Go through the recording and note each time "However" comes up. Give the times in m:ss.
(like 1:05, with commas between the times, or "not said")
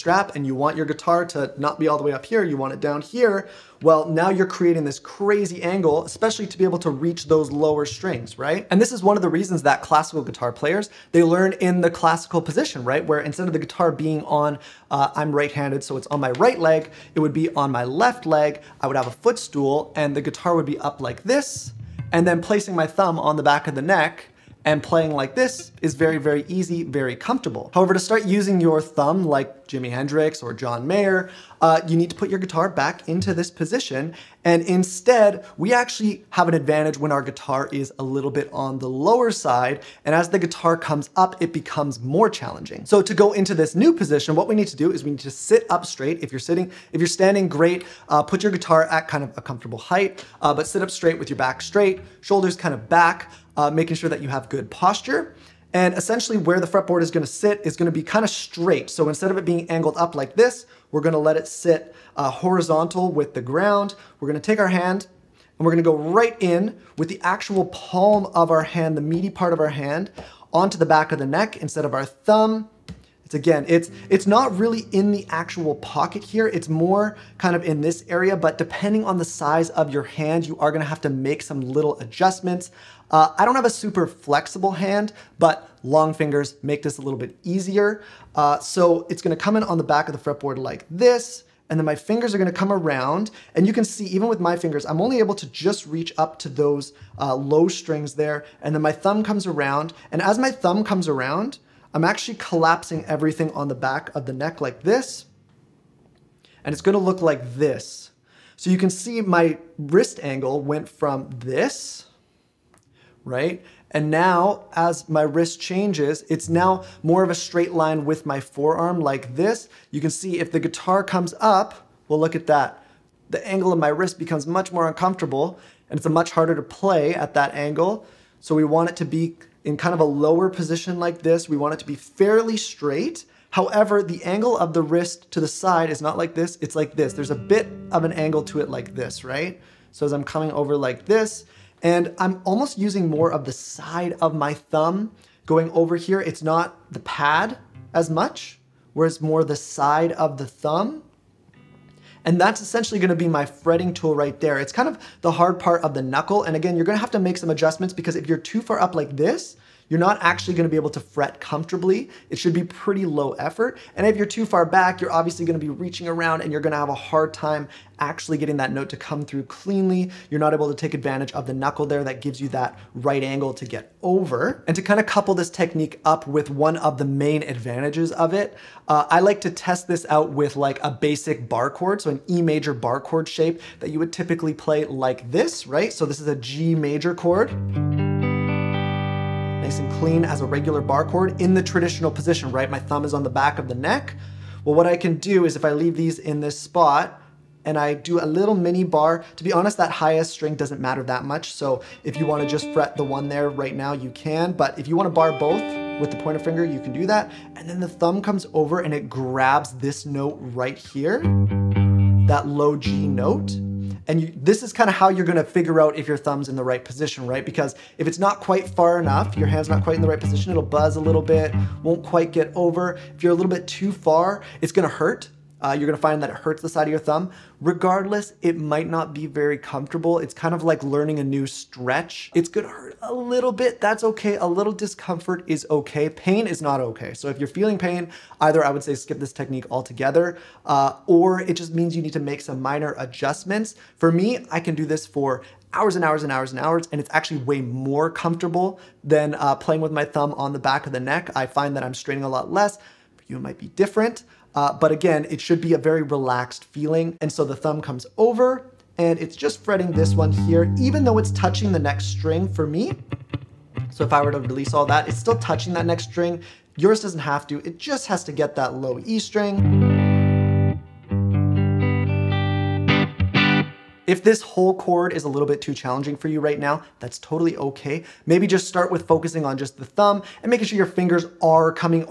0:27, 2:13.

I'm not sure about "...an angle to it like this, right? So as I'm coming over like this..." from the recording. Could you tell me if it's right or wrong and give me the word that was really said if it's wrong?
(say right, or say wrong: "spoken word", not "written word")
right.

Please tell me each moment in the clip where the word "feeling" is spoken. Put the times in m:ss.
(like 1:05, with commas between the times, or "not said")
3:57, 4:16.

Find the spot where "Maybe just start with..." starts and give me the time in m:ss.
4:38.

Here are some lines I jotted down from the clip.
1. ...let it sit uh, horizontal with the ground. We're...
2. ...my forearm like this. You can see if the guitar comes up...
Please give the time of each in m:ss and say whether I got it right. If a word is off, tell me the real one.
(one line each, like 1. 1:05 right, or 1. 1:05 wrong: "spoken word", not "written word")
1. 1:01 right
2. 1:58 right.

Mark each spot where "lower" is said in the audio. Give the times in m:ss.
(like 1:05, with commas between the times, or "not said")
0:07, 0:38, 2:10.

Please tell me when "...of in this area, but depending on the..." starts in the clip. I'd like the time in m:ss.
1:17.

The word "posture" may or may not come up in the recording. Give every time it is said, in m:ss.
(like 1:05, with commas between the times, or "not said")
0:54.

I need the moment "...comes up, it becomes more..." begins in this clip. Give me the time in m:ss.
0:40.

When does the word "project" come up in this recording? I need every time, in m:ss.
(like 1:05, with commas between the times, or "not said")
not said.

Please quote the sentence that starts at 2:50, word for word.
You're not able to take advantage of the knuckle there that gives you that right angle to get over.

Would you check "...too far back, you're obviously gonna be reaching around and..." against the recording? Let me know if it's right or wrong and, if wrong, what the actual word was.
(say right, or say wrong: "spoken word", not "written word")
right.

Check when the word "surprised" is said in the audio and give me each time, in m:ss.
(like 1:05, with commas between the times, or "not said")
not said.